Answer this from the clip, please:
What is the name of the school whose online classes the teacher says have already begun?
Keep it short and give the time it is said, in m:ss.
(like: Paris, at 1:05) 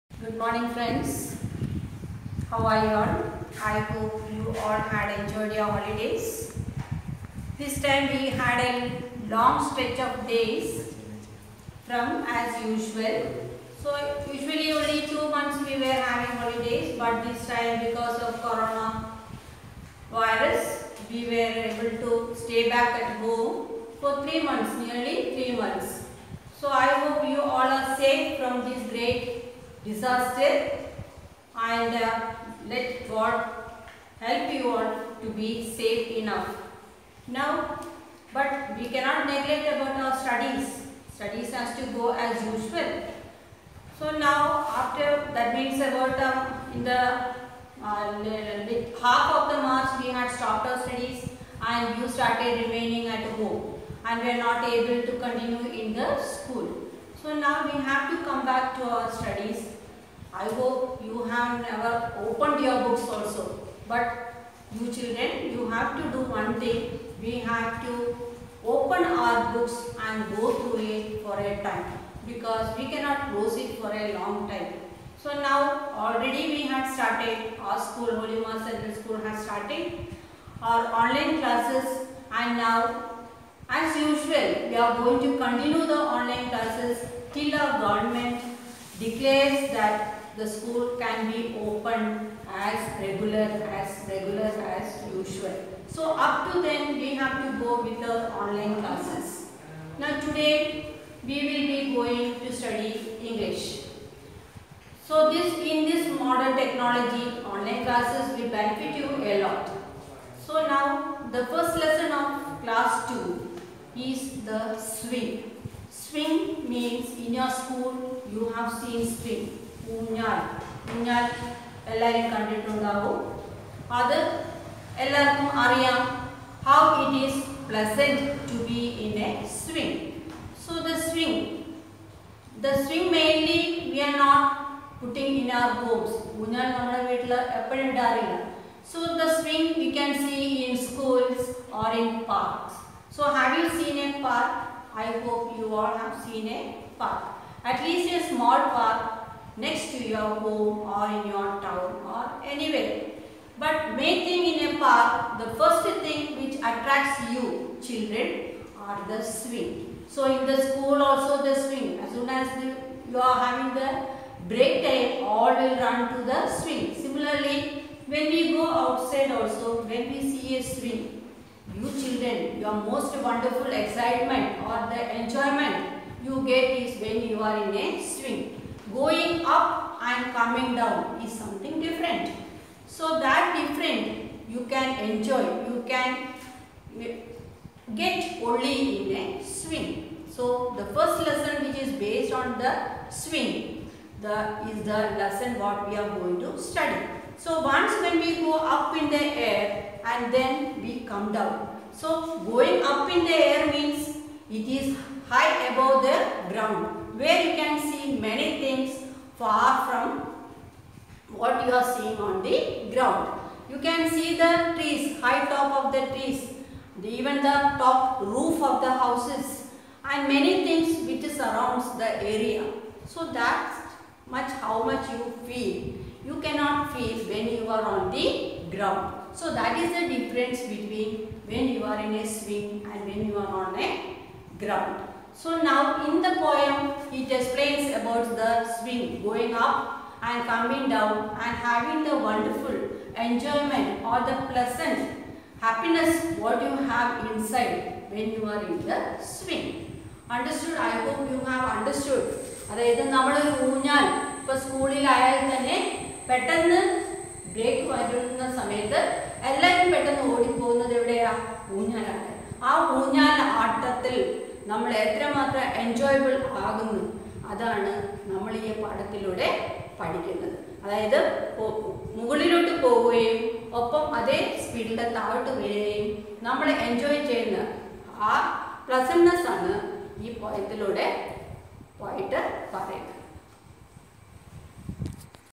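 Holy Mass Central School, at 1:18.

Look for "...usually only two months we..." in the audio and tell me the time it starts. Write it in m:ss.
0:14.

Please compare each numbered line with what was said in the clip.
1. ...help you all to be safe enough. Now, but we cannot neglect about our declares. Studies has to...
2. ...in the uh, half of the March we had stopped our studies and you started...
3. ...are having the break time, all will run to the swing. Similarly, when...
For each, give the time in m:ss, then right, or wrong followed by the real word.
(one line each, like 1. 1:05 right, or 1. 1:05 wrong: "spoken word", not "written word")
1. 0:34 wrong: "studies", not "declares"
2. 0:46 right
3. 2:43 right.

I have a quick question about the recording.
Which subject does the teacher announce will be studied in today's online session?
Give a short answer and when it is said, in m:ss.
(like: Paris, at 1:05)
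English, at 1:43.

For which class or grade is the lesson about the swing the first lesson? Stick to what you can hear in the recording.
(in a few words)
Class 2.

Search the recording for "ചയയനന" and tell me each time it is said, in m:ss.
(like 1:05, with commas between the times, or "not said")
4:37.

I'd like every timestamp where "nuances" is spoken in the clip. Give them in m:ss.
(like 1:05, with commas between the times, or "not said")
not said.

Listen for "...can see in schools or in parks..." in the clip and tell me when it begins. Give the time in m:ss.
2:19.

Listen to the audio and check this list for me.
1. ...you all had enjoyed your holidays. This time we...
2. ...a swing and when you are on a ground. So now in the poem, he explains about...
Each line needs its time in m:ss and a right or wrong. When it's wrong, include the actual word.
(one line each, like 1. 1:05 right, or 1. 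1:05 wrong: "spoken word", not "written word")
1. 0:04 right
2. 3:52 right.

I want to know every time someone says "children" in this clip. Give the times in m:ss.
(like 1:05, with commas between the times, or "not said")
1:04, 2:37, 2:52.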